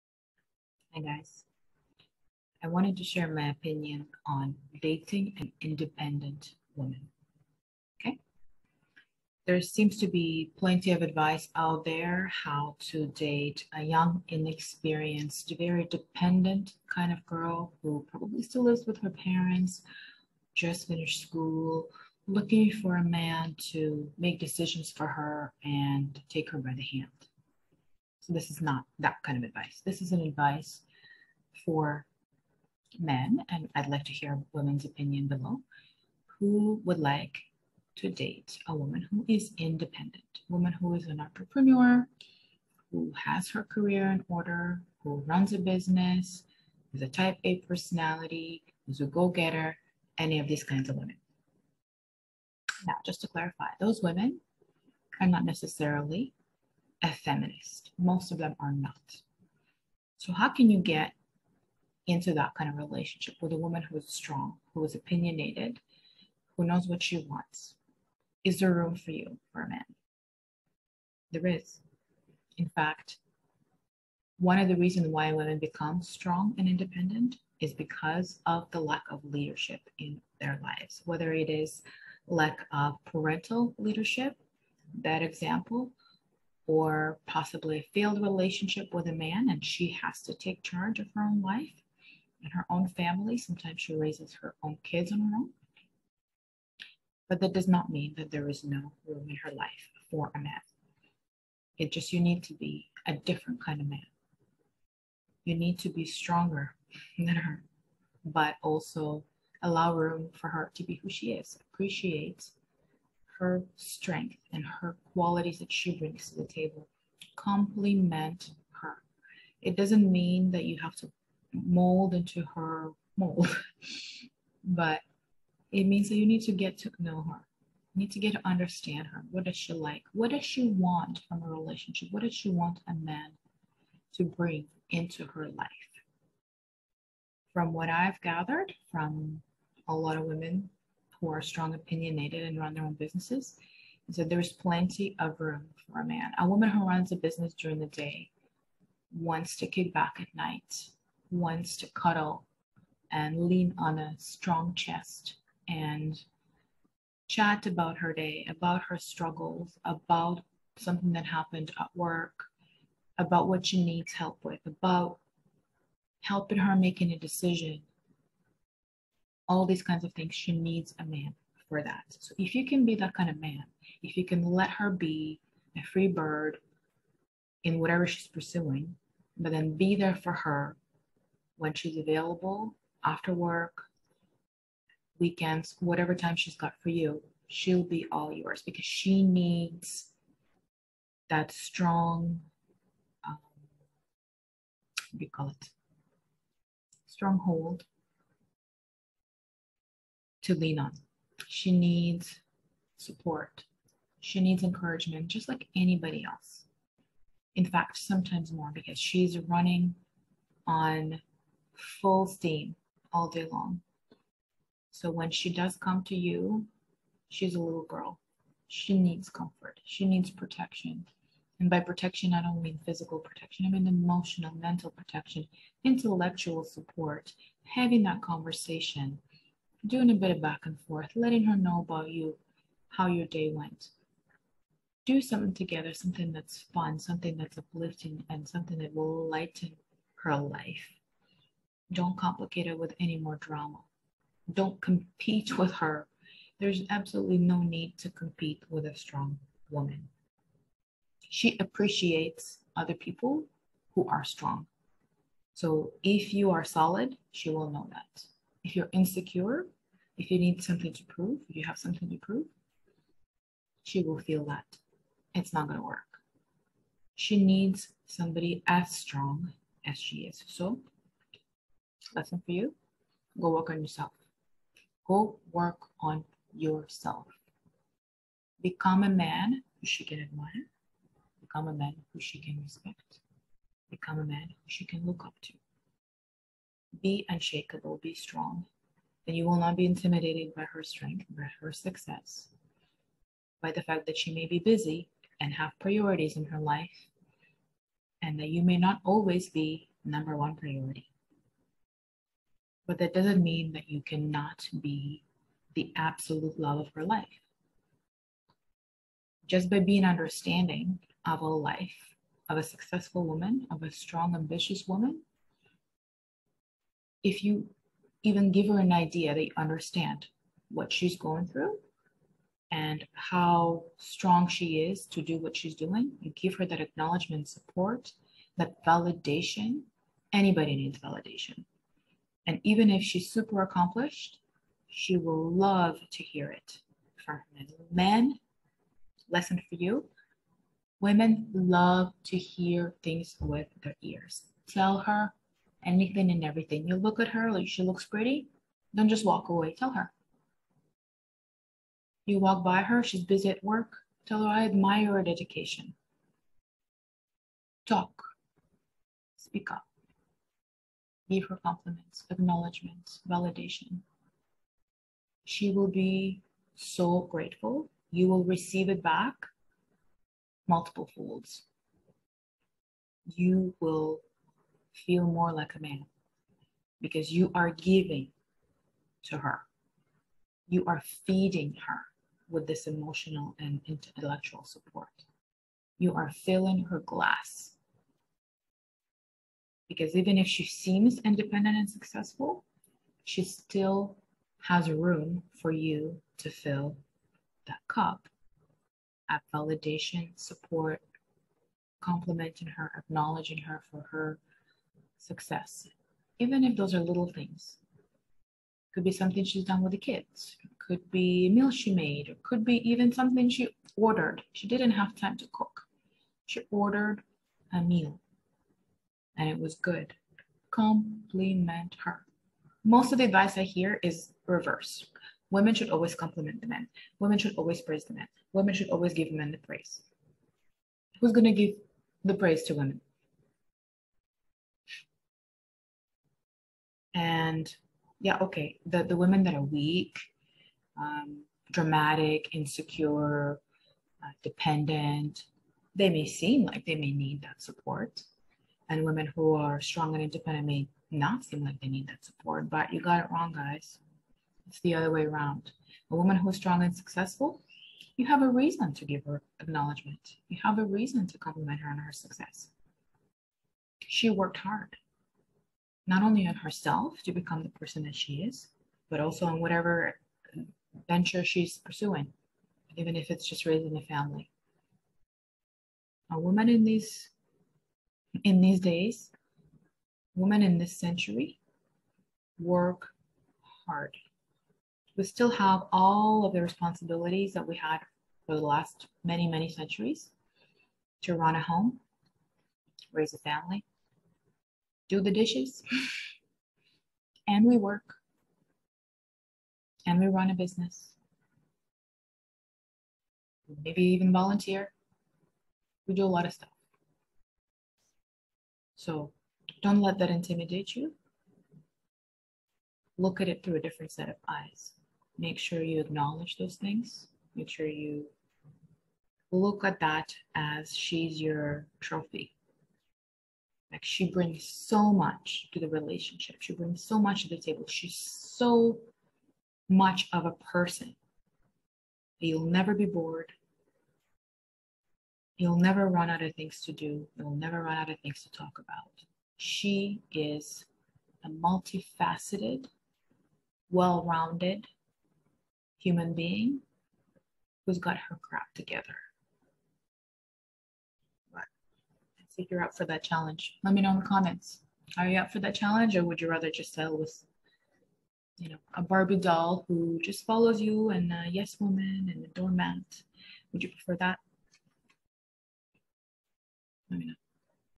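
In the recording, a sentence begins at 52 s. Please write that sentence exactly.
Now, just to clarify, those women are not necessarily a feminist.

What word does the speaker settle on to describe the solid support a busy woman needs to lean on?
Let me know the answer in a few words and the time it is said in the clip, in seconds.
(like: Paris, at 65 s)
Stronghold, at 197 s.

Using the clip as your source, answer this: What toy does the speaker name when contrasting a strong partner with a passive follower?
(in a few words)
Barbie doll.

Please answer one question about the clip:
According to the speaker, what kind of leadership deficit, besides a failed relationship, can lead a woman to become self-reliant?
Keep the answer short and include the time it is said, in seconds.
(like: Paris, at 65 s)
Parental leadership, at 83 s.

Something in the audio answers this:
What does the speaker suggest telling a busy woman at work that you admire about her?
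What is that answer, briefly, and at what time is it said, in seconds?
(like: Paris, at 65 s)
Her dedication, at 355 s.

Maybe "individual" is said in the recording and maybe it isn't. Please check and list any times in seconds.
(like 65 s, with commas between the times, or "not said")
not said.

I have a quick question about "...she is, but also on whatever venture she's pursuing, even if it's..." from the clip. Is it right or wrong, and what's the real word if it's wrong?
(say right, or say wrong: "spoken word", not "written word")
right.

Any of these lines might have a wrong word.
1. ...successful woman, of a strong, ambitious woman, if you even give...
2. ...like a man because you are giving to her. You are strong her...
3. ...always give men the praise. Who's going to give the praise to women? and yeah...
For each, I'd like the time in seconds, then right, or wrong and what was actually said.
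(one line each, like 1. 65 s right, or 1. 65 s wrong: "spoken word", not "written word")
1. 312 s right
2. 375 s wrong: "feeding", not "strong"
3. 428 s right.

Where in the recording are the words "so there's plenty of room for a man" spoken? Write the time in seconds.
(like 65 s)
144 s.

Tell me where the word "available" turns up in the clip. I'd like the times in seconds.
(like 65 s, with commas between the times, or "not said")
181 s.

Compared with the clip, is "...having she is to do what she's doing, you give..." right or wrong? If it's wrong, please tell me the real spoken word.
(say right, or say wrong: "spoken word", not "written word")
wrong: "strong", not "having".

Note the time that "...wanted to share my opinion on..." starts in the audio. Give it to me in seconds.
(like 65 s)
2 s.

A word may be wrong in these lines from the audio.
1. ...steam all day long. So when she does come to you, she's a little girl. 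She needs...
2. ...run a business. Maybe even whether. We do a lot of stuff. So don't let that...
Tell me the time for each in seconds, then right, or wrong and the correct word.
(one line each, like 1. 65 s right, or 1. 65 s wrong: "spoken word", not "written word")
1. 212 s right
2. 500 s wrong: "volunteer", not "whether".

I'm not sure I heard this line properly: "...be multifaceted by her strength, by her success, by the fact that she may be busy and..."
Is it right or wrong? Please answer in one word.
wrong.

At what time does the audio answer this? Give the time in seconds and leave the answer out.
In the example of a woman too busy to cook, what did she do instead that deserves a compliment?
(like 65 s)
416 s.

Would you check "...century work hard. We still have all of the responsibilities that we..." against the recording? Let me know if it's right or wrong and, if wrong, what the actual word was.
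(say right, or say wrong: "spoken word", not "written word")
right.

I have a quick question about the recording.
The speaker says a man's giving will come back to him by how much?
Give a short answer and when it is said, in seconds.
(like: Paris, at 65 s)
Multiple folds, at 370 s.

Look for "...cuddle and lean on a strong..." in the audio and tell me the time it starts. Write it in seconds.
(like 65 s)
151 s.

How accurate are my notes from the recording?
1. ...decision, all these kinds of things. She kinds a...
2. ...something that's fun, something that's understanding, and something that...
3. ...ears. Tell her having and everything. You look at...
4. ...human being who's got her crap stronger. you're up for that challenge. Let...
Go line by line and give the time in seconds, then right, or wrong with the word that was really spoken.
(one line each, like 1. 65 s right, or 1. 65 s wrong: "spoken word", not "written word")
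1. 167 s wrong: "needs", not "kinds"
2. 235 s wrong: "uplifting", not "understanding"
3. 344 s wrong: "anything", not "having"
4. 545 s wrong: "together", not "stronger".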